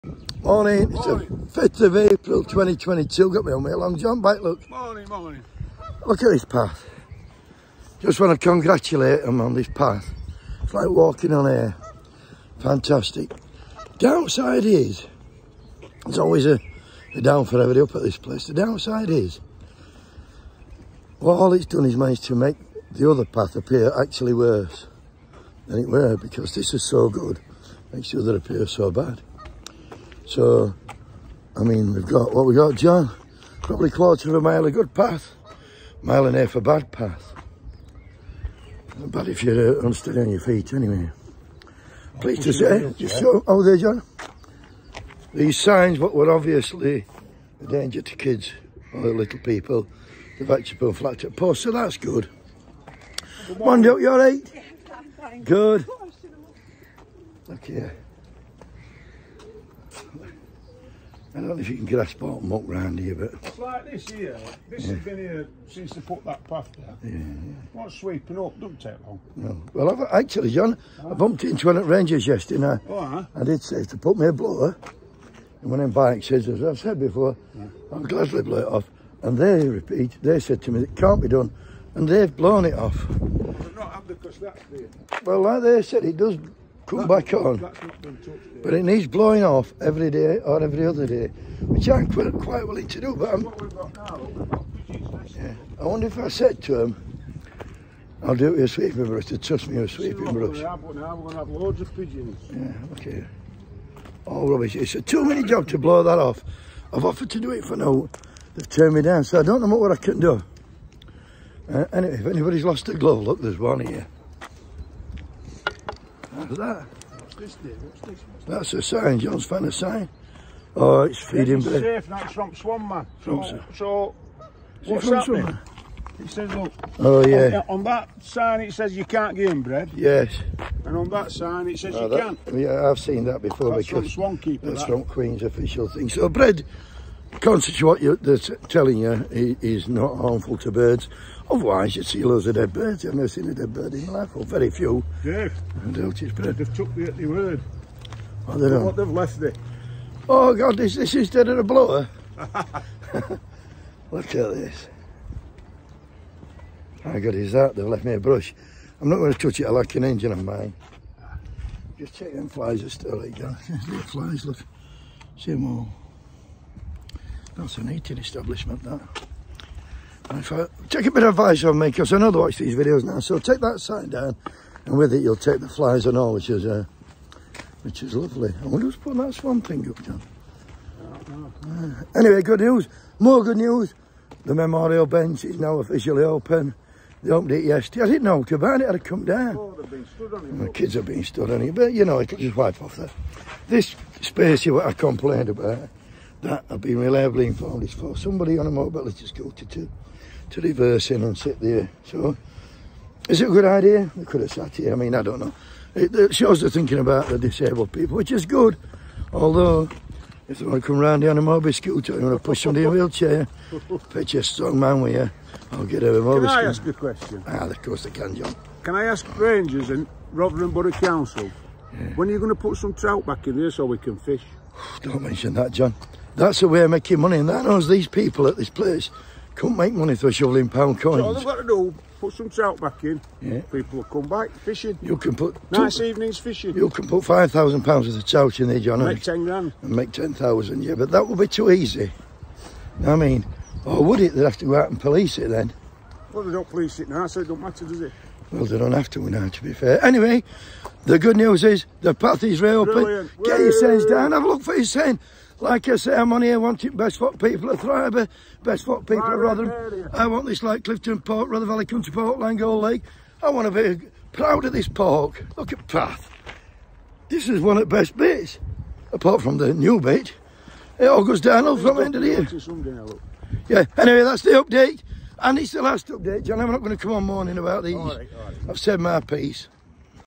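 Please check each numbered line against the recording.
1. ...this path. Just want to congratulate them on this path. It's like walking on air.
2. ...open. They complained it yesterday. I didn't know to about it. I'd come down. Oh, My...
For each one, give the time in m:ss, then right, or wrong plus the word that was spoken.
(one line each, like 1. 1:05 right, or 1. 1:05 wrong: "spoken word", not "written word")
1. 0:06 right
2. 3:06 wrong: "opened", not "complained".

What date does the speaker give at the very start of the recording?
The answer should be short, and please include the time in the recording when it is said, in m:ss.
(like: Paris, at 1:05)
5 April 2022, at 0:01.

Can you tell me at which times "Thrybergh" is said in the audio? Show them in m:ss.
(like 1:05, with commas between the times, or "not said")
4:17.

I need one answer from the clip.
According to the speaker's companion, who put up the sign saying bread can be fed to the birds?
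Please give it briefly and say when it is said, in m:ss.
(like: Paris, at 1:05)
Swankeeper, at 2:14.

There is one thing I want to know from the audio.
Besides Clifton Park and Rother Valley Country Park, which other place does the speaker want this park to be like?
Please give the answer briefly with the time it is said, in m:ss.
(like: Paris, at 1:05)
Langold Lake, at 4:22.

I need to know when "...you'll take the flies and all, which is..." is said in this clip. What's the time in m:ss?
2:55.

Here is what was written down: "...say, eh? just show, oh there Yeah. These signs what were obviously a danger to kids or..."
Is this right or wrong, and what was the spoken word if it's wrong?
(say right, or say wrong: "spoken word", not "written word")
wrong: "John", not "Yeah".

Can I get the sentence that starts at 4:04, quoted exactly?
They'd have to go out and police it then.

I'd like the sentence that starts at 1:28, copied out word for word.
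but it needs blowing off every day or every other day, which I'm quite, quite willing to do.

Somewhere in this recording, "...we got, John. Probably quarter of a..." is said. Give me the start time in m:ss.
0:32.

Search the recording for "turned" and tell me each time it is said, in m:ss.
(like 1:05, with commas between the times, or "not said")
1:48.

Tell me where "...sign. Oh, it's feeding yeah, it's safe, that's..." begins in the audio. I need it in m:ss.
1:59.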